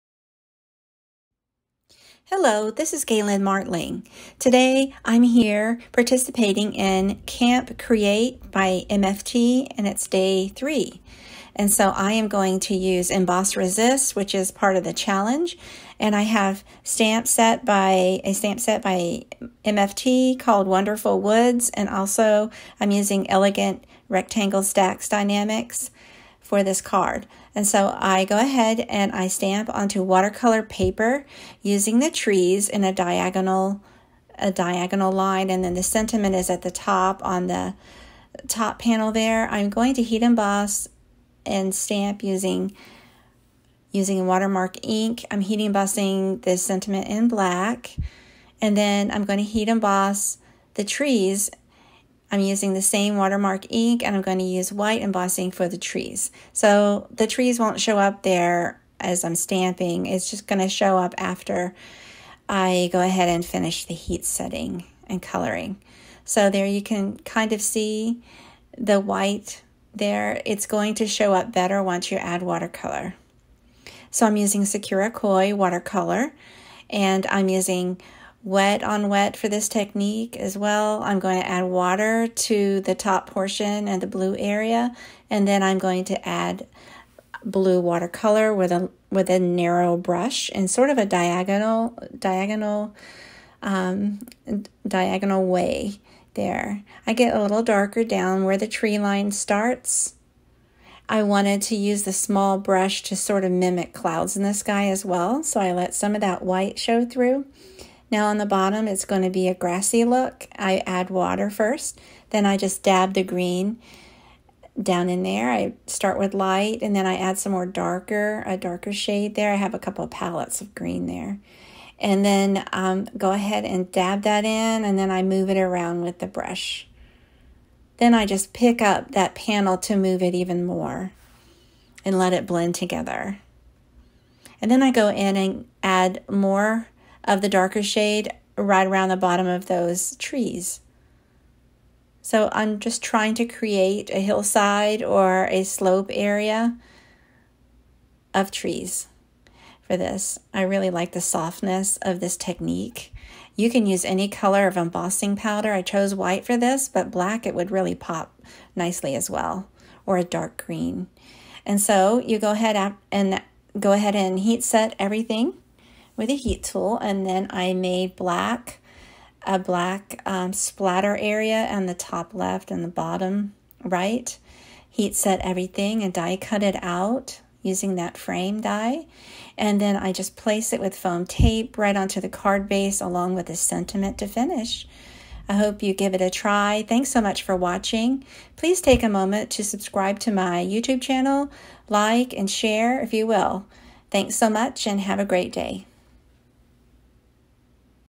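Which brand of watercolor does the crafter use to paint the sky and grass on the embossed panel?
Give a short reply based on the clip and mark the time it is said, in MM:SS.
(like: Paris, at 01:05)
Sakura Koi, at 01:14.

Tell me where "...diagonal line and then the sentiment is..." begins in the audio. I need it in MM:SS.
00:34.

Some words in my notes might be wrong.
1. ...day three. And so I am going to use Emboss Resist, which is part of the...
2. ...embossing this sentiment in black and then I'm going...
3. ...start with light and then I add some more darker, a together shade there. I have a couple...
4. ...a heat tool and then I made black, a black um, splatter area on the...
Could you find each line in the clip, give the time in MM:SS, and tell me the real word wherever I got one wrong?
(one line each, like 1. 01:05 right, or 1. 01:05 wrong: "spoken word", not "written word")
1. 00:10 right
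2. 00:45 right
3. 01:55 wrong: "darker", not "together"
4. 02:46 right.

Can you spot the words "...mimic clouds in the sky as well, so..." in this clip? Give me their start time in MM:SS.
01:43.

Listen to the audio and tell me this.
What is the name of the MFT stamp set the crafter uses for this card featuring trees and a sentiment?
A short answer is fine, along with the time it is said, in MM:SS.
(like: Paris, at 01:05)
Wonderful Woods, at 00:20.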